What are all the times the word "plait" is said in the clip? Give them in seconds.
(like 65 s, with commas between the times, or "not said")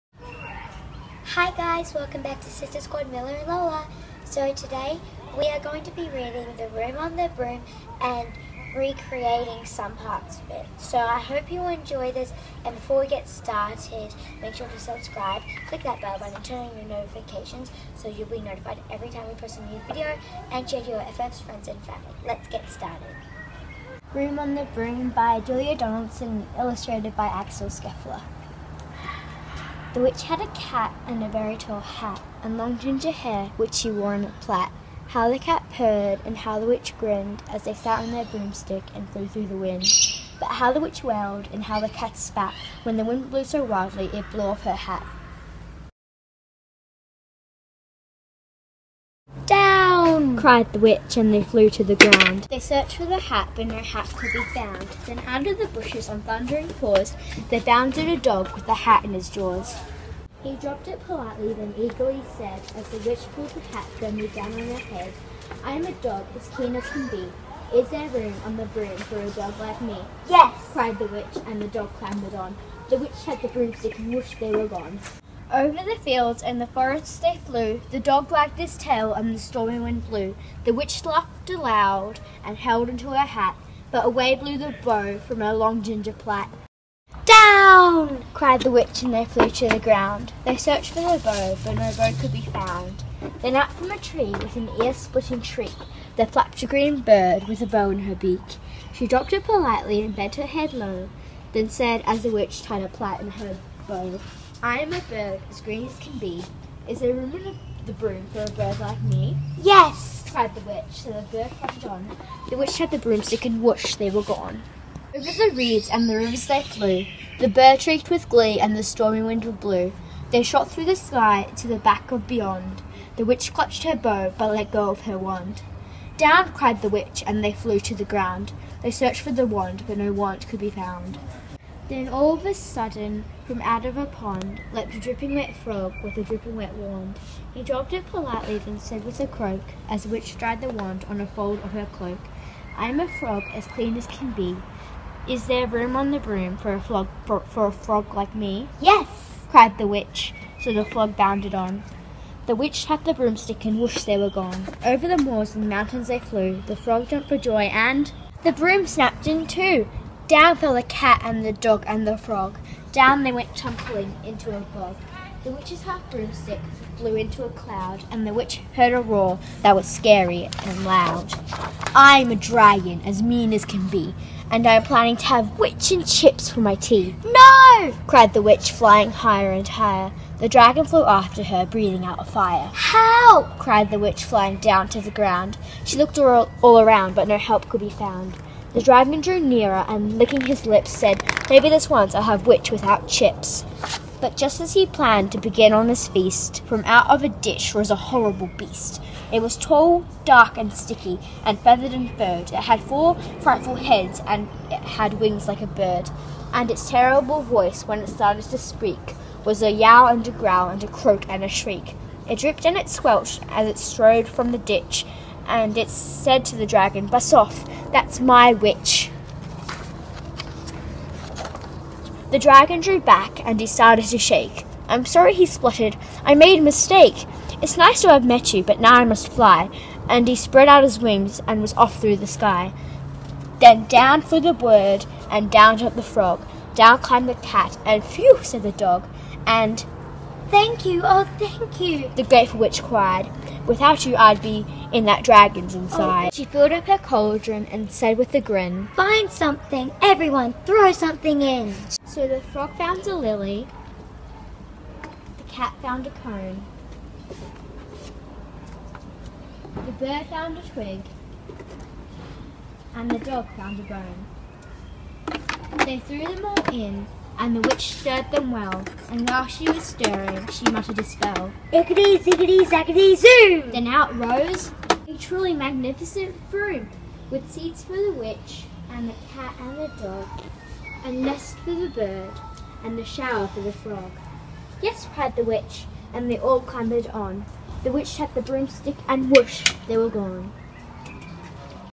34 s, 86 s, 102 s.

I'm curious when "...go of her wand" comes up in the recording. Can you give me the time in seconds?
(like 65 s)
124 s.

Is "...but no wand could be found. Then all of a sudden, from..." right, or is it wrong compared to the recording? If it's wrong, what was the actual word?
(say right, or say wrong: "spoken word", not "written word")
right.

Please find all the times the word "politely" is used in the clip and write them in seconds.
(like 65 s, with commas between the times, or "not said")
61 s, 99 s, 138 s.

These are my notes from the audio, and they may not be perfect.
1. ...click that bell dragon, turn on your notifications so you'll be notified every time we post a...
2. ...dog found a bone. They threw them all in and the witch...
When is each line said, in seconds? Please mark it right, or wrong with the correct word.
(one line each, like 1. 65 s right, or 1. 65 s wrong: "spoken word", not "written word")
1. 15 s wrong: "button", not "dragon"
2. 263 s right.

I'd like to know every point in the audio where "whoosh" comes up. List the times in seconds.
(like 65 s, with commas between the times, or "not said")
113 s, 153 s, 289 s.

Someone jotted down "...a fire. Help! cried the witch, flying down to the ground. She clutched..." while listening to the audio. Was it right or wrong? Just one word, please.
wrong.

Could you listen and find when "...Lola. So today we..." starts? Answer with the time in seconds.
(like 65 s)
3 s.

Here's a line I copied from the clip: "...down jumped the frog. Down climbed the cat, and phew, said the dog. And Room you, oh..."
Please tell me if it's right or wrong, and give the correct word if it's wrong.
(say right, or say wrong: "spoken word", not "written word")
wrong: "Thank", not "Room".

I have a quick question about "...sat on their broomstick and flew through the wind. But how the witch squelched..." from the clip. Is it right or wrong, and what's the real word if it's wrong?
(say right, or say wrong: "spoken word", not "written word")
wrong: "wailed", not "squelched".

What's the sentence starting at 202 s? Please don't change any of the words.
It had four frightful heads, and it had wings like a bird.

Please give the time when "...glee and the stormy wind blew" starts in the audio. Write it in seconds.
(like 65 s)
118 s.